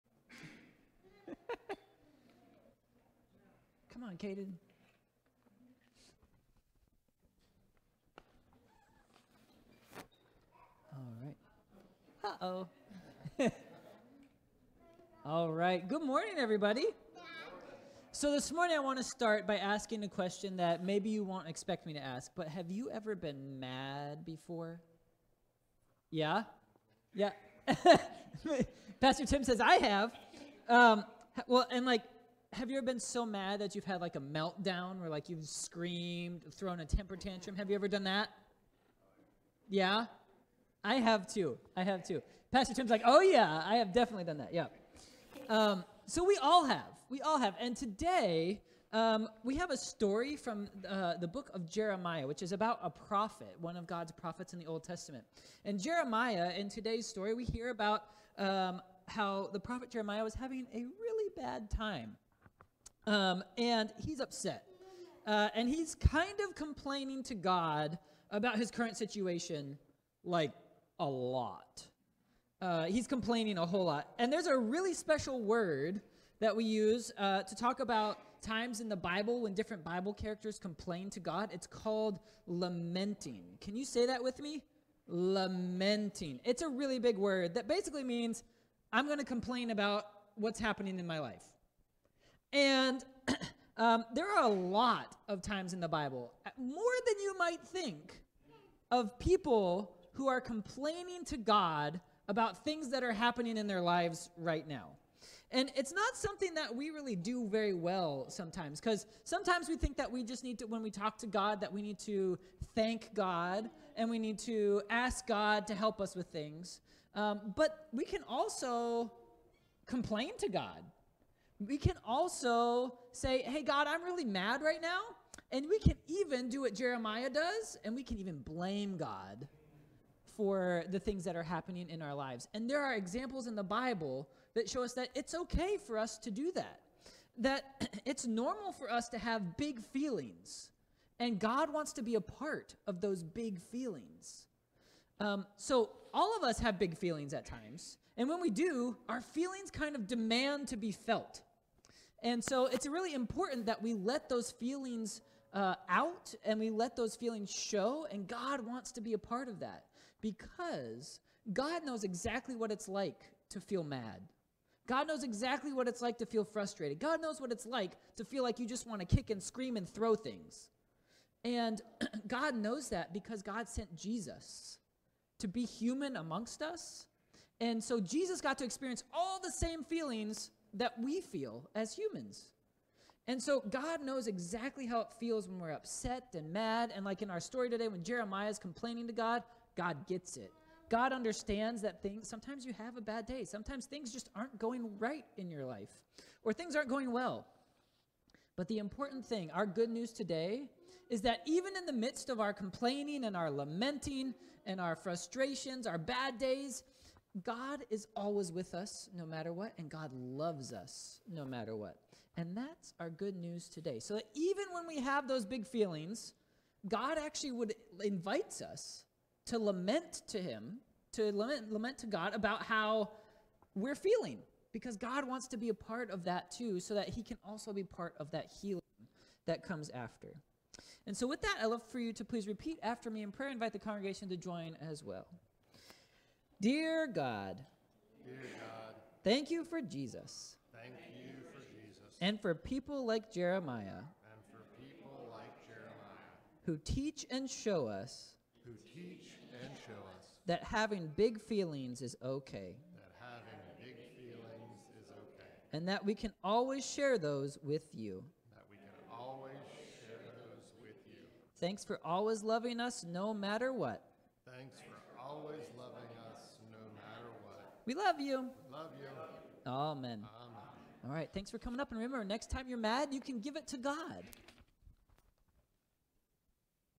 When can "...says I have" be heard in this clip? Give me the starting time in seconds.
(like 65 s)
29 s.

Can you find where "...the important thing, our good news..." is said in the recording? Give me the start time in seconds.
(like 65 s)
198 s.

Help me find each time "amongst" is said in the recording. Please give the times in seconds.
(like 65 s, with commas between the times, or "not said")
176 s.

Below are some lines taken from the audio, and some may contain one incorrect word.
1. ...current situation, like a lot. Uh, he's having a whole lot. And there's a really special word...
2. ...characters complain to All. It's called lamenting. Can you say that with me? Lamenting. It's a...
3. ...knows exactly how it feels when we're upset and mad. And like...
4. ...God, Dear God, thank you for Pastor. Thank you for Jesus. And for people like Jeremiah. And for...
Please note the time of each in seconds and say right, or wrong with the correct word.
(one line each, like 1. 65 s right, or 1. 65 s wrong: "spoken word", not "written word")
1. 68 s wrong: "complaining", not "having"
2. 80 s wrong: "God", not "All"
3. 184 s right
4. 237 s wrong: "Jesus", not "Pastor".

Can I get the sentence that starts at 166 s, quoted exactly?
God knows what it's like to feel like you just want to kick and scream and throw things.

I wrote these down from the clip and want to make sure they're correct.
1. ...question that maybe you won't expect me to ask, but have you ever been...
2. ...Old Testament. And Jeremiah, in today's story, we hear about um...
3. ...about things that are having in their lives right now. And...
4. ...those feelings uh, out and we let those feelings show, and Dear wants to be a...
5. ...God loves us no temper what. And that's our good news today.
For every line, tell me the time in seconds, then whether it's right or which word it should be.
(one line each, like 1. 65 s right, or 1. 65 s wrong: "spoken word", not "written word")
1. 20 s right
2. 54 s right
3. 102 s wrong: "happening", not "having"
4. 154 s wrong: "God", not "Dear"
5. 209 s wrong: "matter", not "temper".